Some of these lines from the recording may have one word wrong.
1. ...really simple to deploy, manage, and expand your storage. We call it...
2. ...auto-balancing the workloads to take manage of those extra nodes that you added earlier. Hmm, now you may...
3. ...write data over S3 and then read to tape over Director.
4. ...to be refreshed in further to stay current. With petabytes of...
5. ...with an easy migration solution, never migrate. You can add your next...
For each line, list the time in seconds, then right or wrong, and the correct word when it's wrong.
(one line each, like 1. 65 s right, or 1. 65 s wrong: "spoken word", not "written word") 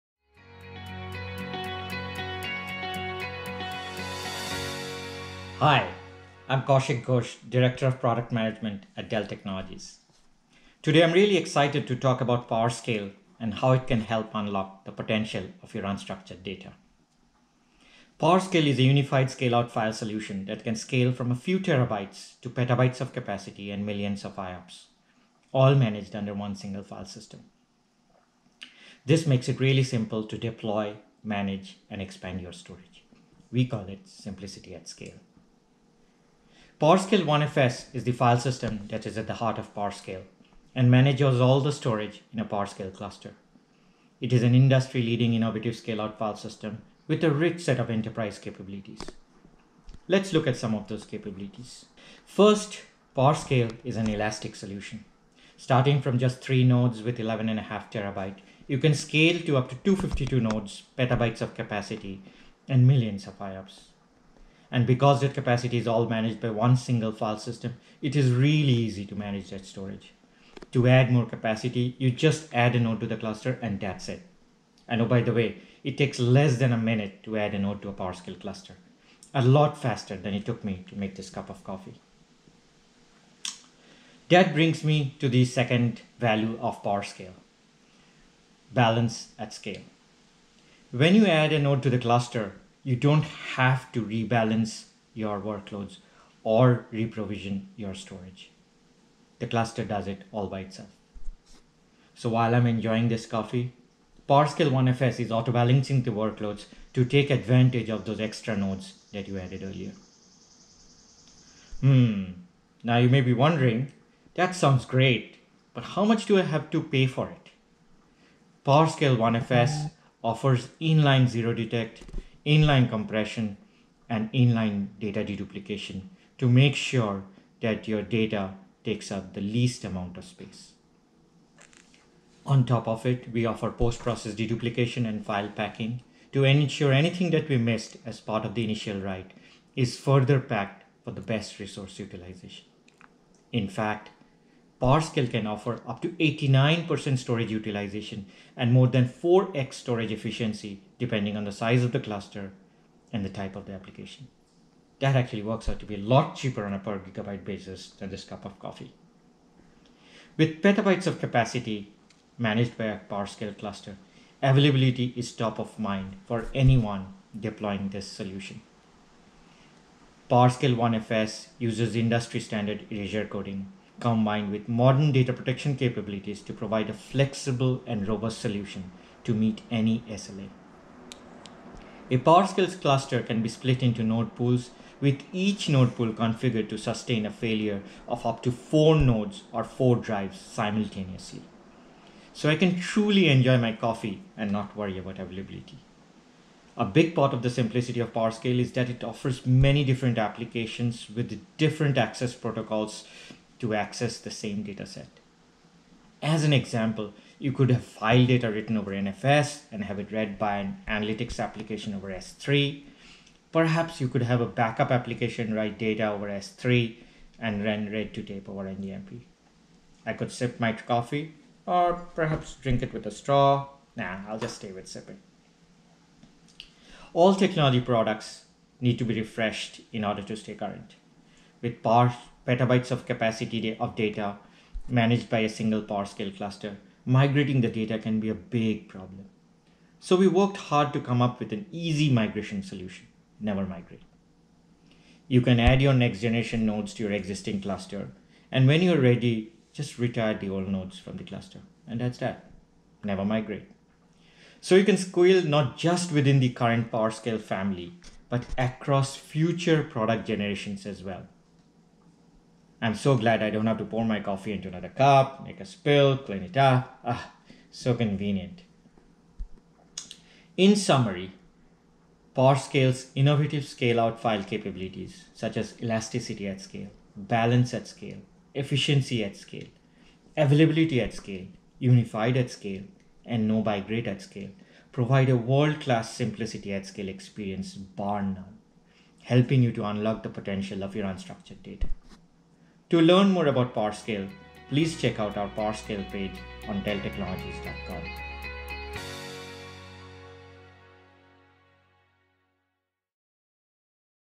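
1. 29 s right
2. 105 s wrong: "advantage", not "manage"
3. 215 s wrong: "NDMP", not "Director"
4. 228 s wrong: "order", not "further"
5. 241 s right.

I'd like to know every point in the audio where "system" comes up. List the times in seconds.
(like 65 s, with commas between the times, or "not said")
27 s, 38 s, 46 s, 67 s.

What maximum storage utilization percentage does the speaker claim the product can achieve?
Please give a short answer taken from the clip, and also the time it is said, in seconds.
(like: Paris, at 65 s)
89%, at 146 s.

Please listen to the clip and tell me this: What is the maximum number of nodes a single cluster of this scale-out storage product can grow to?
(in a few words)
252.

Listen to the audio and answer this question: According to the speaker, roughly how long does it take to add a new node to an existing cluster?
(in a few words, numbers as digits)
less than a minute.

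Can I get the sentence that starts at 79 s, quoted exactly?
A lot faster than it took me to make this cup of coffee.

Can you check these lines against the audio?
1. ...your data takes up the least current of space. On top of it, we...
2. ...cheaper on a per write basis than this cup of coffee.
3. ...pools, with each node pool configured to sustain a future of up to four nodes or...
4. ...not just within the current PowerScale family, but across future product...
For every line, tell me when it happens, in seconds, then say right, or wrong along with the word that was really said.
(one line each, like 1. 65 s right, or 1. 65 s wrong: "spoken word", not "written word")
1. 127 s wrong: "amount", not "current"
2. 156 s wrong: "gigabyte", not "write"
3. 184 s wrong: "failure", not "future"
4. 255 s right.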